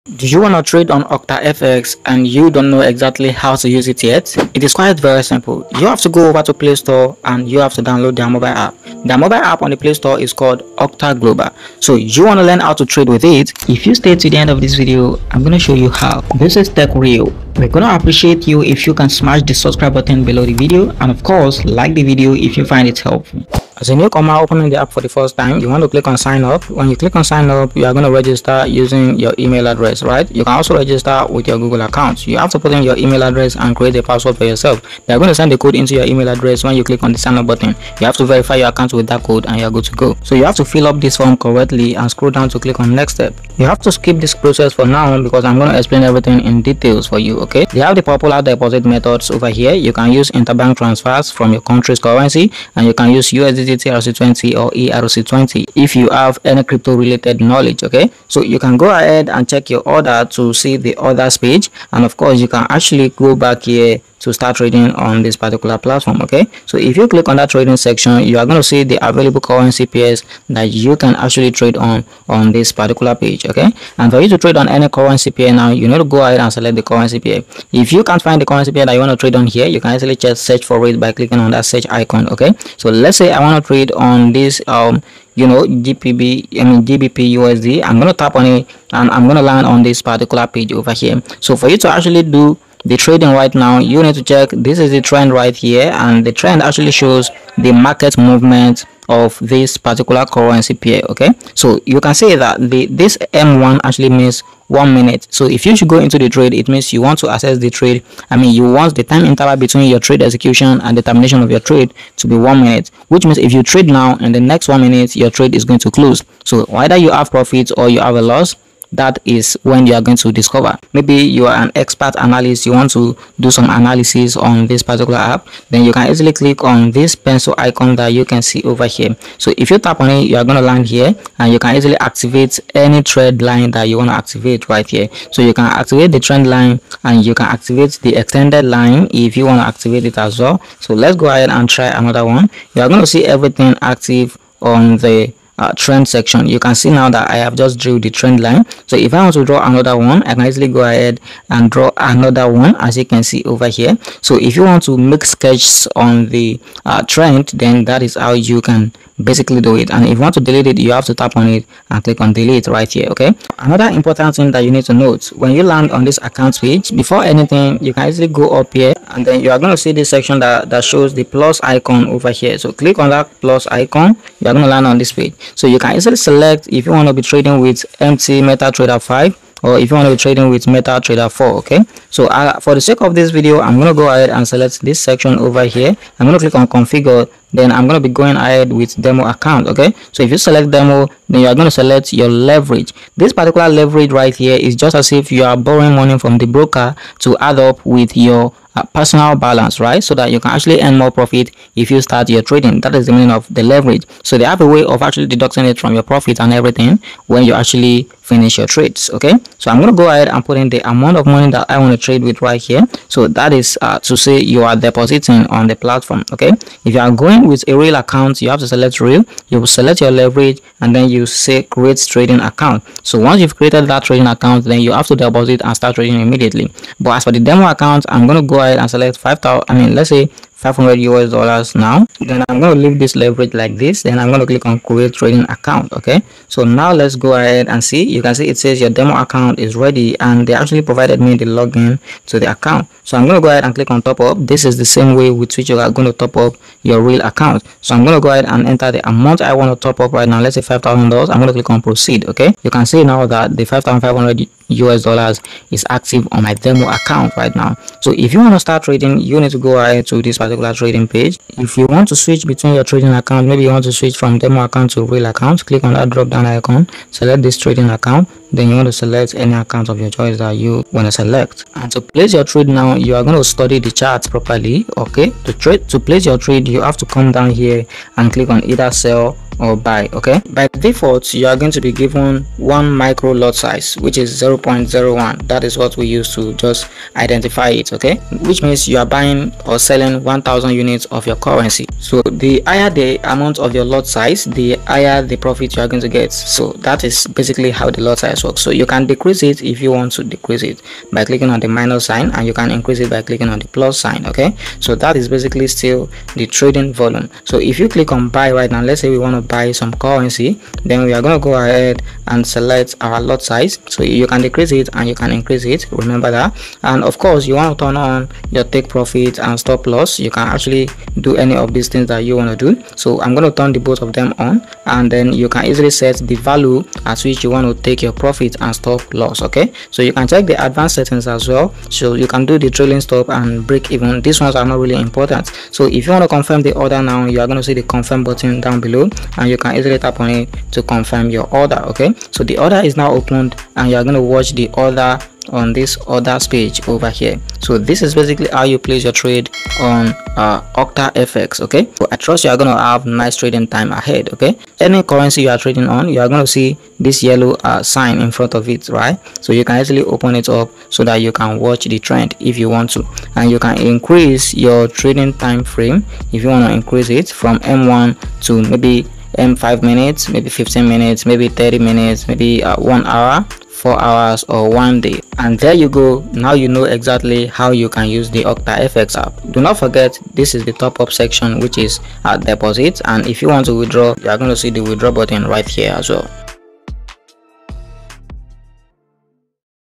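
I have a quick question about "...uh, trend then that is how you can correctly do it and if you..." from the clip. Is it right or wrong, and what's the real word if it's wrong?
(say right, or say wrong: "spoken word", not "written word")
wrong: "basically", not "correctly".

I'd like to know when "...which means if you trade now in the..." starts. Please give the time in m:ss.
1:53.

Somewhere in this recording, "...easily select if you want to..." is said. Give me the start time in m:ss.
2:55.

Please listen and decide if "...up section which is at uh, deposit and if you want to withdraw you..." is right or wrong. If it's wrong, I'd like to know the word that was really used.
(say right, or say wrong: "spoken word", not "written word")
right.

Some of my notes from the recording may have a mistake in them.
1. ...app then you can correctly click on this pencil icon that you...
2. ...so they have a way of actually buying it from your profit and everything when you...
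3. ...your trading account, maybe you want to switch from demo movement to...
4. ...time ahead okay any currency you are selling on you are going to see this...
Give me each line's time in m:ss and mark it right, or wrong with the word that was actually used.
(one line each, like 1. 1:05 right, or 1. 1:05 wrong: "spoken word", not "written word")
1. 2:05 wrong: "easily", not "correctly"
2. 3:24 wrong: "deducting", not "buying"
3. 4:22 wrong: "account", not "movement"
4. 5:53 wrong: "trading", not "selling".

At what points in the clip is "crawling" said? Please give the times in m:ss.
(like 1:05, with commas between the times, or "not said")
not said.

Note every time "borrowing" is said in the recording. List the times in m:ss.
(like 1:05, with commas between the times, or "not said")
3:15.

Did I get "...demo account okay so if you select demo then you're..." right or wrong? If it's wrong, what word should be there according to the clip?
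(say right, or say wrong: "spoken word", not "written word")
right.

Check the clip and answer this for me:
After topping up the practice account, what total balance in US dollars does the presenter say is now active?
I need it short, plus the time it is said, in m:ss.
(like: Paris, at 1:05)
5500, at 4:13.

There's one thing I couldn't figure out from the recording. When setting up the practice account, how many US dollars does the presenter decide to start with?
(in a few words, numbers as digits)
500.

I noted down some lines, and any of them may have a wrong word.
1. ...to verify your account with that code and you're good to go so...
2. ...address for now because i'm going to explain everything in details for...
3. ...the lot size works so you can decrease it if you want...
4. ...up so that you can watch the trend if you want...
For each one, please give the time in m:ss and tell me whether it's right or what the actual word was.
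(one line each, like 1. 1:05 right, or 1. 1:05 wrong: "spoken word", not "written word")
1. 0:38 right
2. 0:44 wrong: "process", not "address"
3. 4:57 right
4. 6:00 right.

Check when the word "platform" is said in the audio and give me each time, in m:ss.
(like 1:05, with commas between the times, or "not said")
1:05, 3:35.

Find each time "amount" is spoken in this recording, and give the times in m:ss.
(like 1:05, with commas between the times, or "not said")
3:30, 4:09, 4:53.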